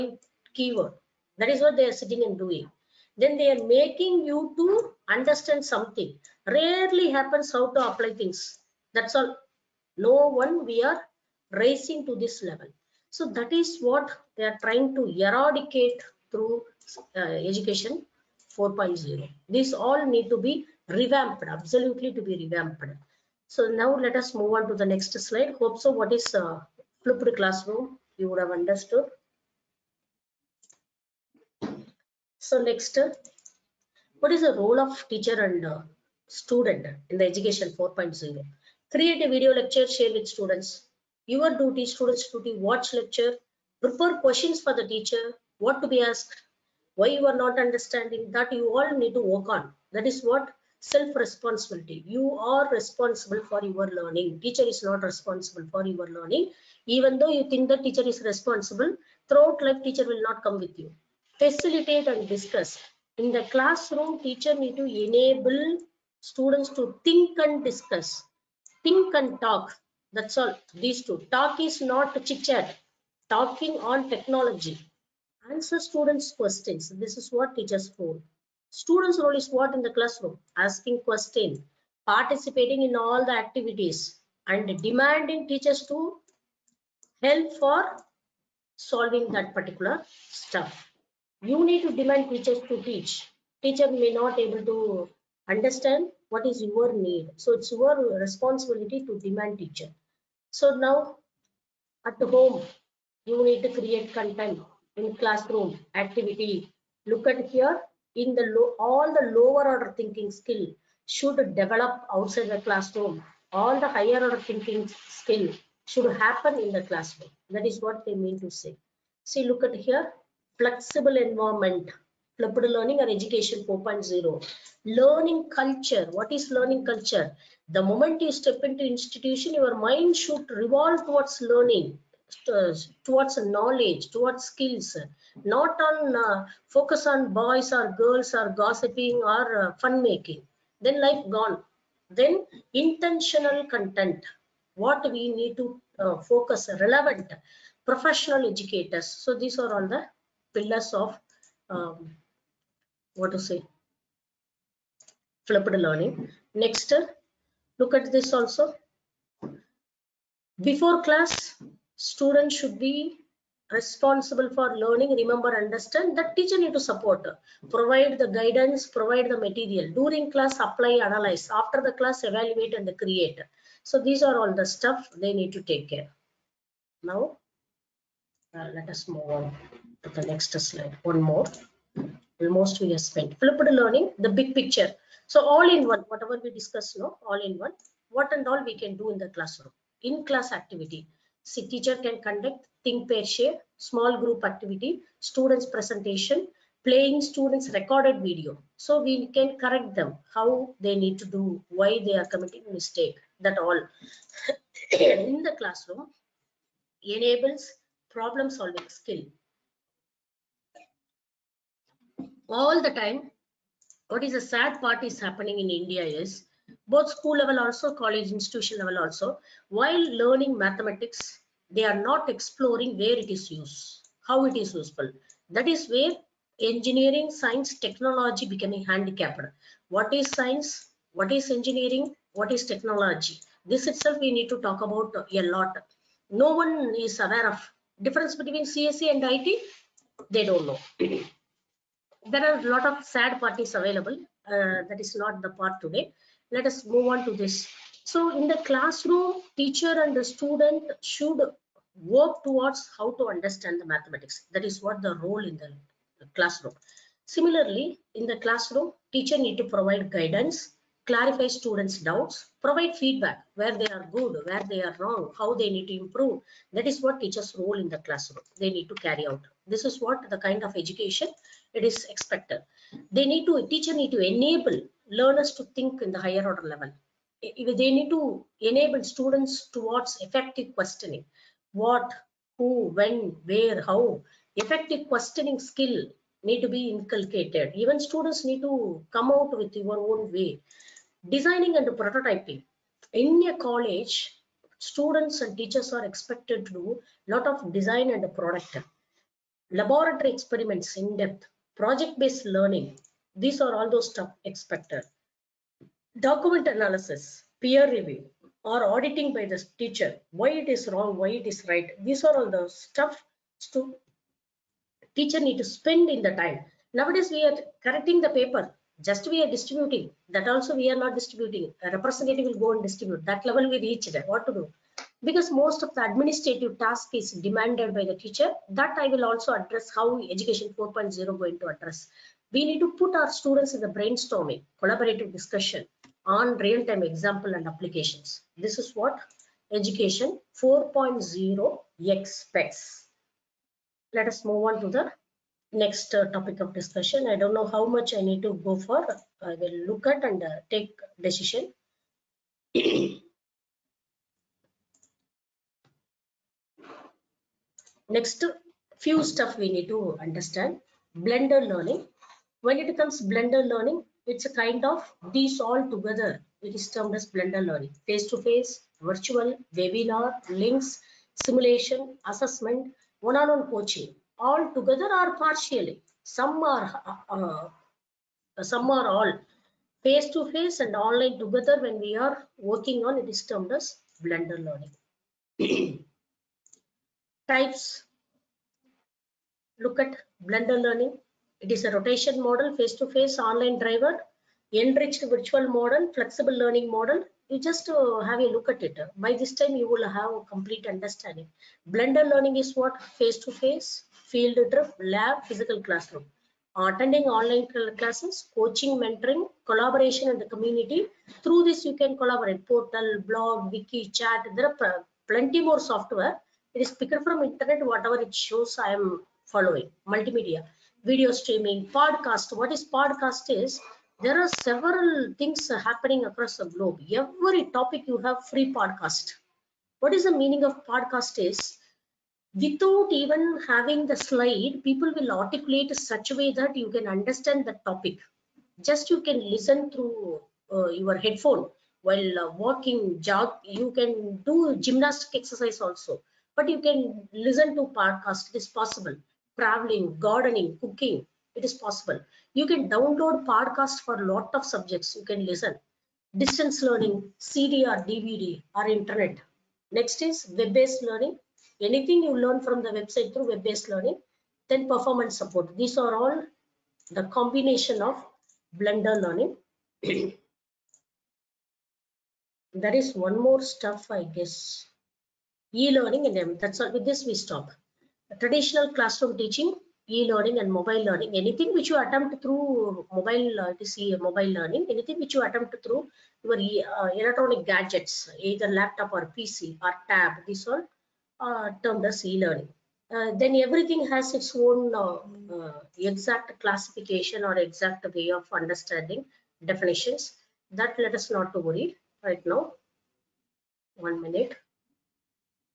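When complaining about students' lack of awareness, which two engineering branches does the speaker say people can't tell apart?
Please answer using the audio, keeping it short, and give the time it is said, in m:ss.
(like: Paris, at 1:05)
CSE and IT, at 3:58.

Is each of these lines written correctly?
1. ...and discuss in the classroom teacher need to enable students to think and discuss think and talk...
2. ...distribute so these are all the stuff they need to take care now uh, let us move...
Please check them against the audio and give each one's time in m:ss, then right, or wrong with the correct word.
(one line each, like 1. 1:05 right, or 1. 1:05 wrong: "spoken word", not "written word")
1. 1:02 right
2. 2:53 wrong: "create", not "distribute".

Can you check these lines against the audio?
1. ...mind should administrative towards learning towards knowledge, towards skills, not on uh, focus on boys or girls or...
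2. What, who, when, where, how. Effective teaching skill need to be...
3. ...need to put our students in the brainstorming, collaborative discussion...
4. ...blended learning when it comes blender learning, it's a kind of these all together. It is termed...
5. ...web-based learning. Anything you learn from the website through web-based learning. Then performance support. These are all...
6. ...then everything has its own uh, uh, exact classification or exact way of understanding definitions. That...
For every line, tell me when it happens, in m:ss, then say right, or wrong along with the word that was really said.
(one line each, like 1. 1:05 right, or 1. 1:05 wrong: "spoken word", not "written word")
1. 2:09 wrong: "revolve", not "administrative"
2. 4:41 wrong: "questioning", not "teaching"
3. 5:32 right
4. 6:01 right
5. 7:40 right
6. 8:13 right.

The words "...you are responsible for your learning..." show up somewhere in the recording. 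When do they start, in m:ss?
0:52.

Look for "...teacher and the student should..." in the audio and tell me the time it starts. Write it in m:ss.
4:09.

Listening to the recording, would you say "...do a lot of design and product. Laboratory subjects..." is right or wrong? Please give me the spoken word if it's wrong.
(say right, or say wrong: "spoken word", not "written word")
wrong: "experiments", not "subjects".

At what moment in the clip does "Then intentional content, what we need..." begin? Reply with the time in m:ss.
2:22.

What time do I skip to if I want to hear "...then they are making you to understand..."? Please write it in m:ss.
0:03.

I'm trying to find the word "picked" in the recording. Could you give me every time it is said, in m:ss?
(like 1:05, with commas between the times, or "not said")
6:57.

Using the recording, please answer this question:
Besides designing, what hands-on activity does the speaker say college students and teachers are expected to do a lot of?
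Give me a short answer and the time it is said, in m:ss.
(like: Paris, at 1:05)
Prototyping, at 4:51.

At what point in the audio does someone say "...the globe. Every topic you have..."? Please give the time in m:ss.
7:06.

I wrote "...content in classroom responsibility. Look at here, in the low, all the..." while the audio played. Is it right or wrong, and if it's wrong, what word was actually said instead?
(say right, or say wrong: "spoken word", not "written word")
wrong: "activity", not "responsibility".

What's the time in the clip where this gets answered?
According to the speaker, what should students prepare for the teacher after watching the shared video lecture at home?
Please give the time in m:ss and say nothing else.
0:43.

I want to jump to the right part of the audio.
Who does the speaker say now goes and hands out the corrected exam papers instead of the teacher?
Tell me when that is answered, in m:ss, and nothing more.
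5:21.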